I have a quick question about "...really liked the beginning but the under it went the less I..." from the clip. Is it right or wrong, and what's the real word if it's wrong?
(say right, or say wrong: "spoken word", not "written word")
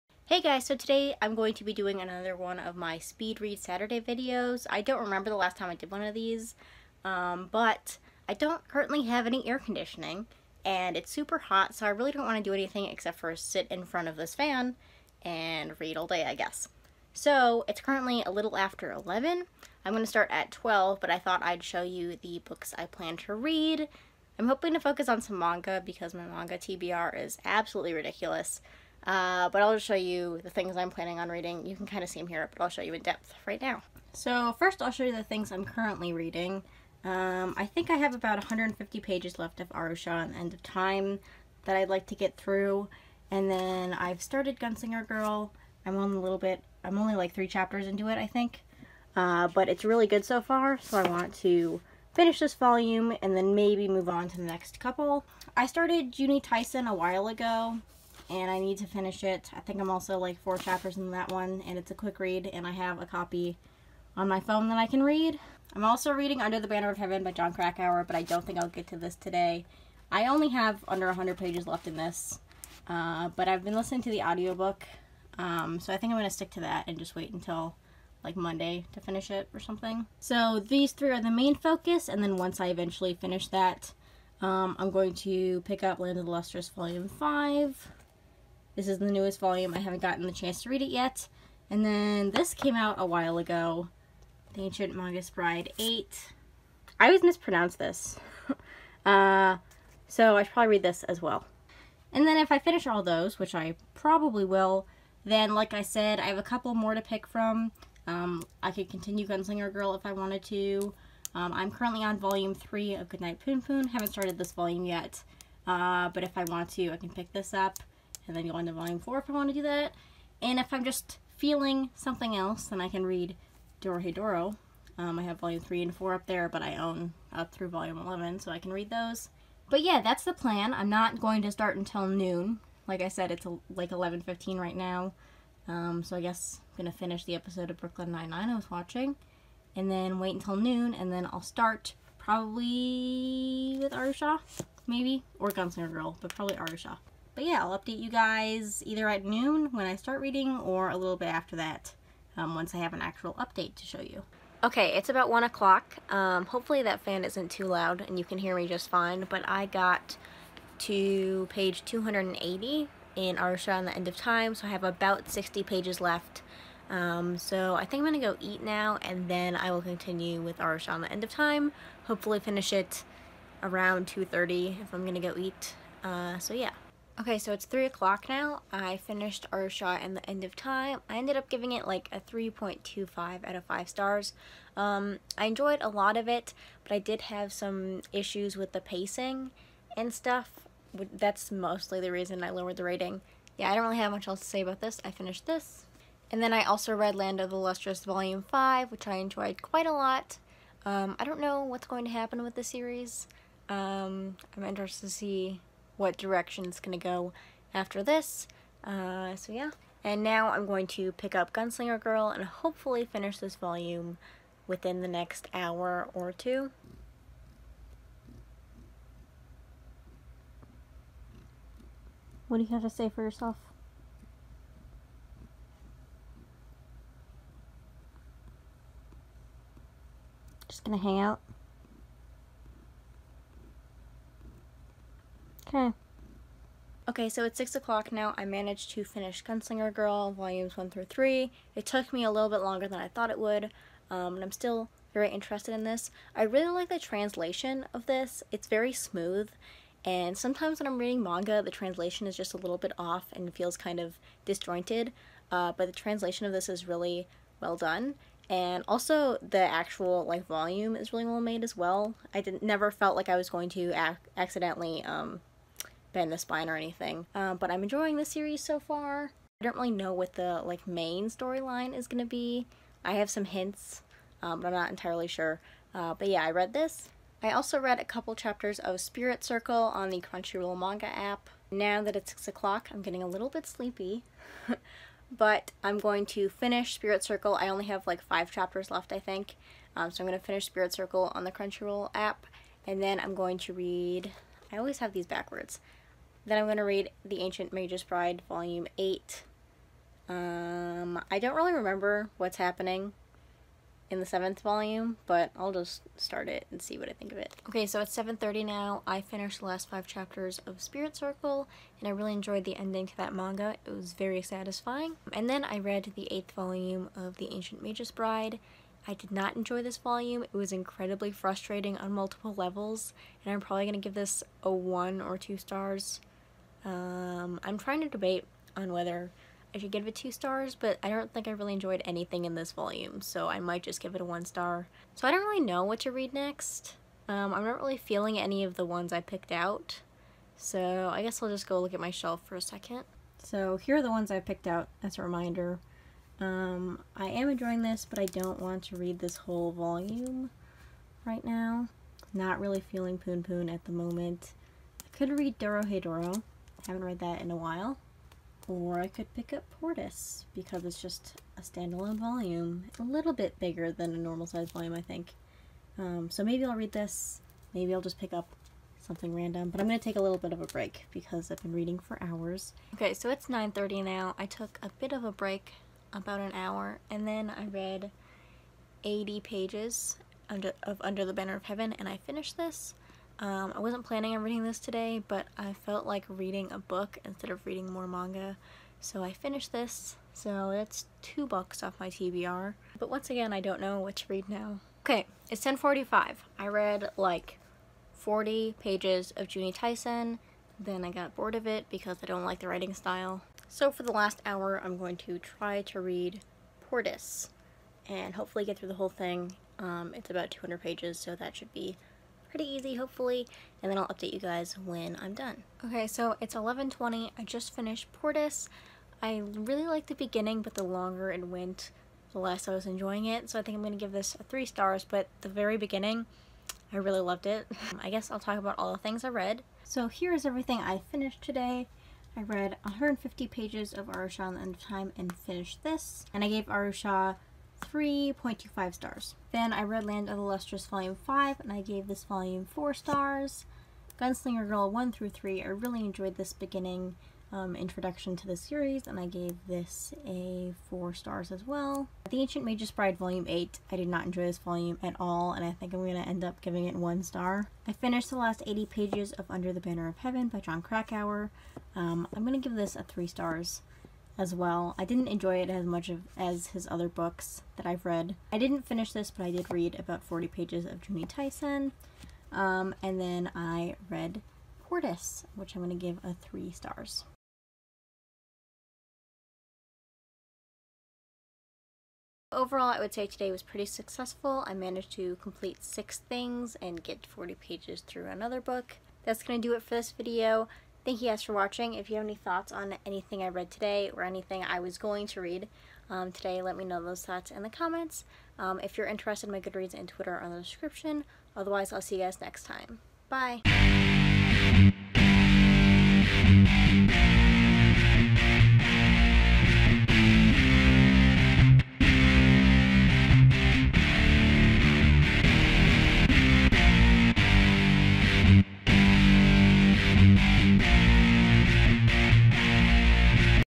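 wrong: "longer", not "under".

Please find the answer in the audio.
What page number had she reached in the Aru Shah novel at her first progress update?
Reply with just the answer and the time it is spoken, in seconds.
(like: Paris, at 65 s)
280, at 161 s.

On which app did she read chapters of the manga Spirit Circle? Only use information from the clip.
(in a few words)
Crunchyroll manga app.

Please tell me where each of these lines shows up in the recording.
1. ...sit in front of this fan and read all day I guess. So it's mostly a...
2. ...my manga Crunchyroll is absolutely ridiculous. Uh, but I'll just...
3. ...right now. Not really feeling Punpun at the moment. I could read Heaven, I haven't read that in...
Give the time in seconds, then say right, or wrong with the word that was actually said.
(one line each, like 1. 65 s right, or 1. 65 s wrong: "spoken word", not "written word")
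1. 13 s wrong: "currently", not "mostly"
2. 26 s wrong: "TBR", not "Crunchyroll"
3. 351 s wrong: "Dorohedoro", not "Heaven".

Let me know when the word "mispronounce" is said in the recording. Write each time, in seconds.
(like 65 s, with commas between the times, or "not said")
97 s.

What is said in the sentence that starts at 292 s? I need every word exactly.
And then I'm going to read...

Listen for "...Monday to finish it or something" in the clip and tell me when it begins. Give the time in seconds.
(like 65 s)
78 s.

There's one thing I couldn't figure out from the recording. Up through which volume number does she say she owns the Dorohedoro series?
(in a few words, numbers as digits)
11.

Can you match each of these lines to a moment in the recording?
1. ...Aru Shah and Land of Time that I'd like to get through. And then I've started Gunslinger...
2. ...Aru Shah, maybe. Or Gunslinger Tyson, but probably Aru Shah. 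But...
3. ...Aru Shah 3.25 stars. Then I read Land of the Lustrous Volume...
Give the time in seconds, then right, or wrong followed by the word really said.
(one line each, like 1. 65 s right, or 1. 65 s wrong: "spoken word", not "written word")
1. 39 s wrong: "End", not "Land"
2. 143 s wrong: "Girl", not "Tyson"
3. 436 s right.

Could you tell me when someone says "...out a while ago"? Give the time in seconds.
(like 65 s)
92 s.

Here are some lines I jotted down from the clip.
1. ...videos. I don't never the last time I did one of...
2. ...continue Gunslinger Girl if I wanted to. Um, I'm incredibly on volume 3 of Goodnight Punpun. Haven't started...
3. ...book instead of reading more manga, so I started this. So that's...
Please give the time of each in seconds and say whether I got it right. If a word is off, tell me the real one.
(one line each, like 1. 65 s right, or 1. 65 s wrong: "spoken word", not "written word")
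1. 3 s wrong: "remember", not "never"
2. 108 s wrong: "currently", not "incredibly"
3. 386 s wrong: "finished", not "started".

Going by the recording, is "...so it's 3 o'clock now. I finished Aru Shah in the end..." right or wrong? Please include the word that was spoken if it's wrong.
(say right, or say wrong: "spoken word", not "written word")
right.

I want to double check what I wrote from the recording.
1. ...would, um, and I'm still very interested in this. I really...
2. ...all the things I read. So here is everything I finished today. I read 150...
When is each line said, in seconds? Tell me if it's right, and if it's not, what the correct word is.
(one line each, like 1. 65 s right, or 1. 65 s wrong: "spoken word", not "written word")
1. 243 s right
2. 428 s right.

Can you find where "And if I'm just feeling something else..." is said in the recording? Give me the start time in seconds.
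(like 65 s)
120 s.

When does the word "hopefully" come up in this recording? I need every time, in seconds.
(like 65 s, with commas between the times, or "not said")
156 s, 172 s, 212 s, 408 s, 412 s.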